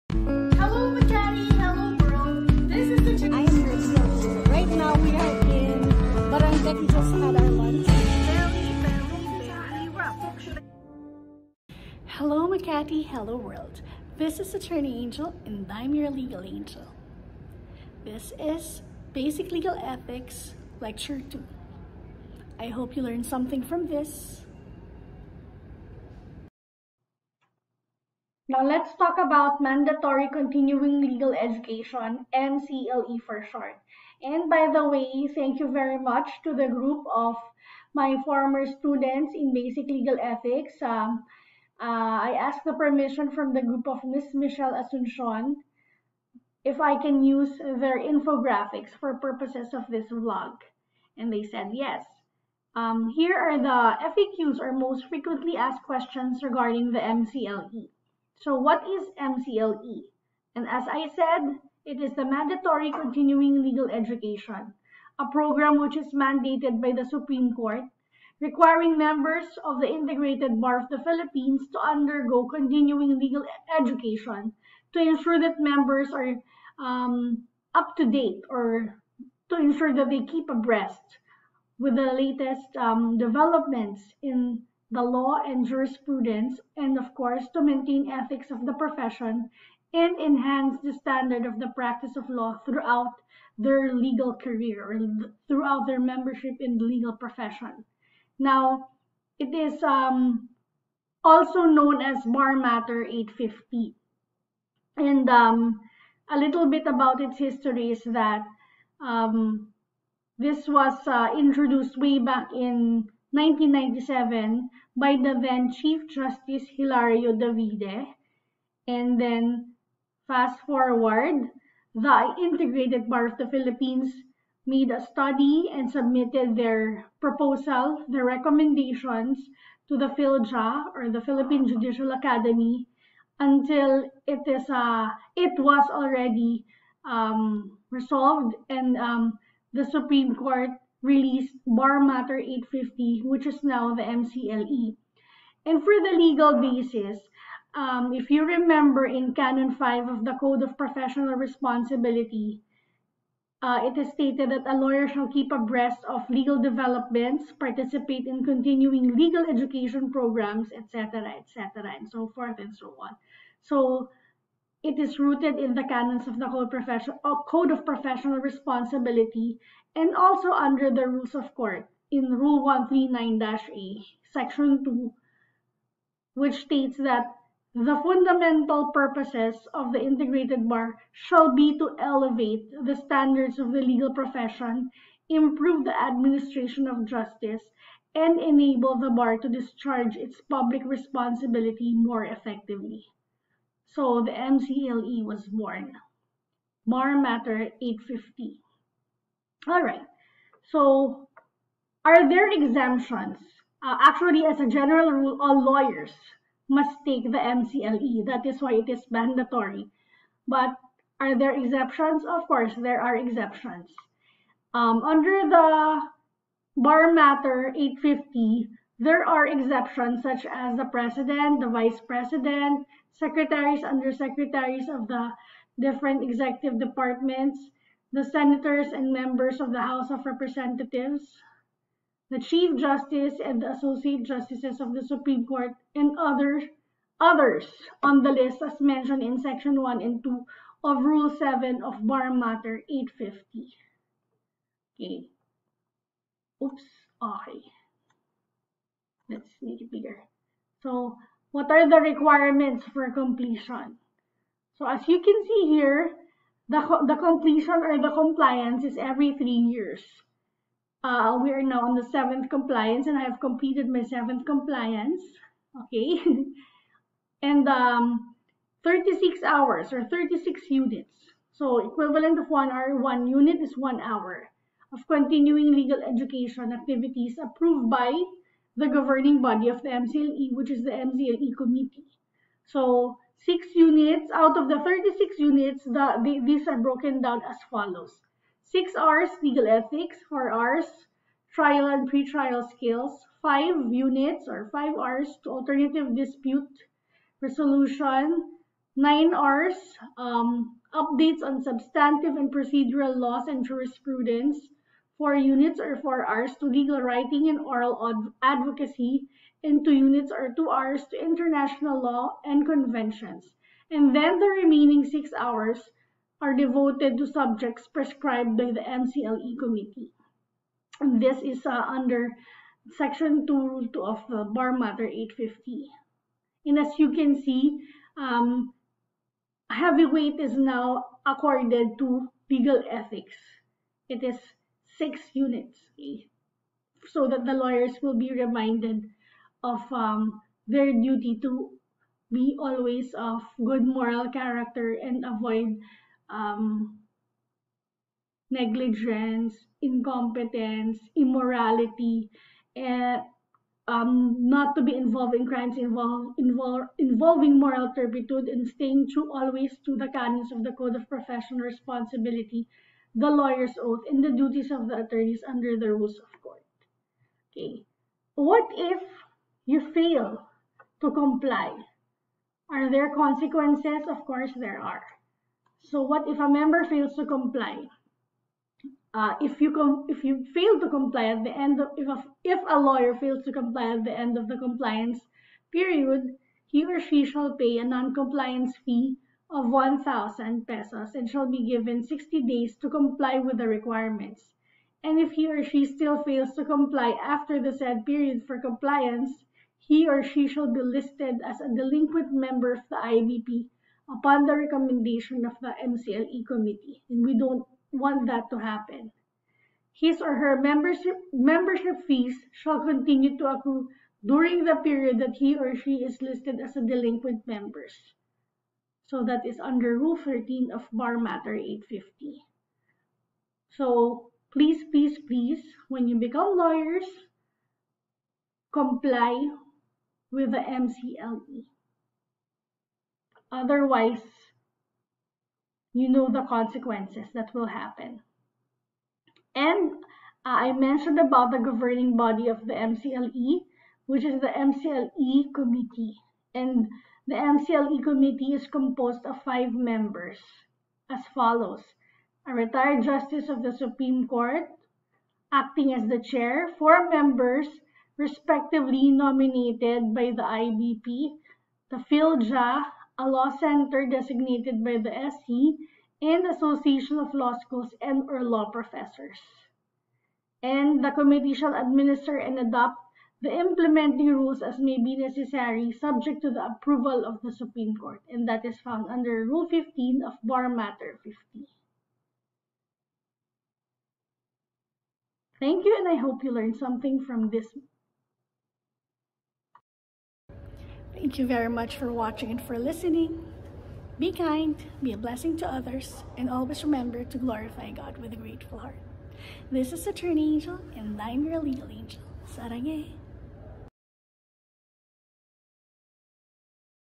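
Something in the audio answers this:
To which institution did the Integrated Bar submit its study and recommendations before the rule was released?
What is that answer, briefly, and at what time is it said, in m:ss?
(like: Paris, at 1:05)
Philippine Judicial Academy, at 2:11.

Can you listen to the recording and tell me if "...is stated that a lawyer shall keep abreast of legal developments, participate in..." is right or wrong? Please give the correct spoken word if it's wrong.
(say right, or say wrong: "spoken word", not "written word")
right.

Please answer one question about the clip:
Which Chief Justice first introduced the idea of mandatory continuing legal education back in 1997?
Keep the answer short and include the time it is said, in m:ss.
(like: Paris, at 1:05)
Hilario Davide, at 1:56.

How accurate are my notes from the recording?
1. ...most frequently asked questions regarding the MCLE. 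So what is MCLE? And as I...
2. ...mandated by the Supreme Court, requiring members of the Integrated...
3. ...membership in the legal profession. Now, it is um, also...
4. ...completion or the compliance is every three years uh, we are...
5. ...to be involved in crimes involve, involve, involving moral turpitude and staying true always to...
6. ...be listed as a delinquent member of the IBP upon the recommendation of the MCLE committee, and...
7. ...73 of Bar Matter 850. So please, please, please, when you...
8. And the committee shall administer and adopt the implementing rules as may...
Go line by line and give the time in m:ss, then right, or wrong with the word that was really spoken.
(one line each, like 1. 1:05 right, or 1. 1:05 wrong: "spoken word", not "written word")
1. 0:54 right
2. 1:06 right
3. 1:35 right
4. 4:17 right
5. 5:54 right
6. 6:40 right
7. 7:00 wrong: "13", not "73"
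8. 7:50 right.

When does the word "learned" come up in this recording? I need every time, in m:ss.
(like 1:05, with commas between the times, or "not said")
0:23, 8:06.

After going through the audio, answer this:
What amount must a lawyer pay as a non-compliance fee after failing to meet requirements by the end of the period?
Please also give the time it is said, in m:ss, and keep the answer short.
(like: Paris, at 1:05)
1,000 pesos, at 6:29.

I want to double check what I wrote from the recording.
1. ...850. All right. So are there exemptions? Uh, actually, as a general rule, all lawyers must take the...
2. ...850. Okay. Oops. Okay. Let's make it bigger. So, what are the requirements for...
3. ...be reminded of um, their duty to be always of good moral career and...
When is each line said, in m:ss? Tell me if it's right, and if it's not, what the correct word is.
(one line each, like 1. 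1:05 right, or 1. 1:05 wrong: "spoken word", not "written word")
1. 3:17 right
2. 4:02 right
3. 5:38 wrong: "character", not "career".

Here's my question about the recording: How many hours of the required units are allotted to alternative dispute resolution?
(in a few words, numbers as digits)
5.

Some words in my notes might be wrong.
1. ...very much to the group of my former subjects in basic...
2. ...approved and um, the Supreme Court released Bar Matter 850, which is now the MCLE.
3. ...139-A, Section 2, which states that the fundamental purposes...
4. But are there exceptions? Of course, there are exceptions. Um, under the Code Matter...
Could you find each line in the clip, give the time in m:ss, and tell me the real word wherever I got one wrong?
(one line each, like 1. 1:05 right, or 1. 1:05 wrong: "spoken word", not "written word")
1. 0:35 wrong: "students", not "subjects"
2. 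2:17 wrong: "resolved", not "approved"
3. 2:52 right
4. 3:30 wrong: "Bar", not "Code".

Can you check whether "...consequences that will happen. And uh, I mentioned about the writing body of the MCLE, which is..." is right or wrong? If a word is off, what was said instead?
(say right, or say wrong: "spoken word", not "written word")
wrong: "governing", not "writing".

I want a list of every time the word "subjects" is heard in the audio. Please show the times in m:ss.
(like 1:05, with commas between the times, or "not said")
5:17, 7:55.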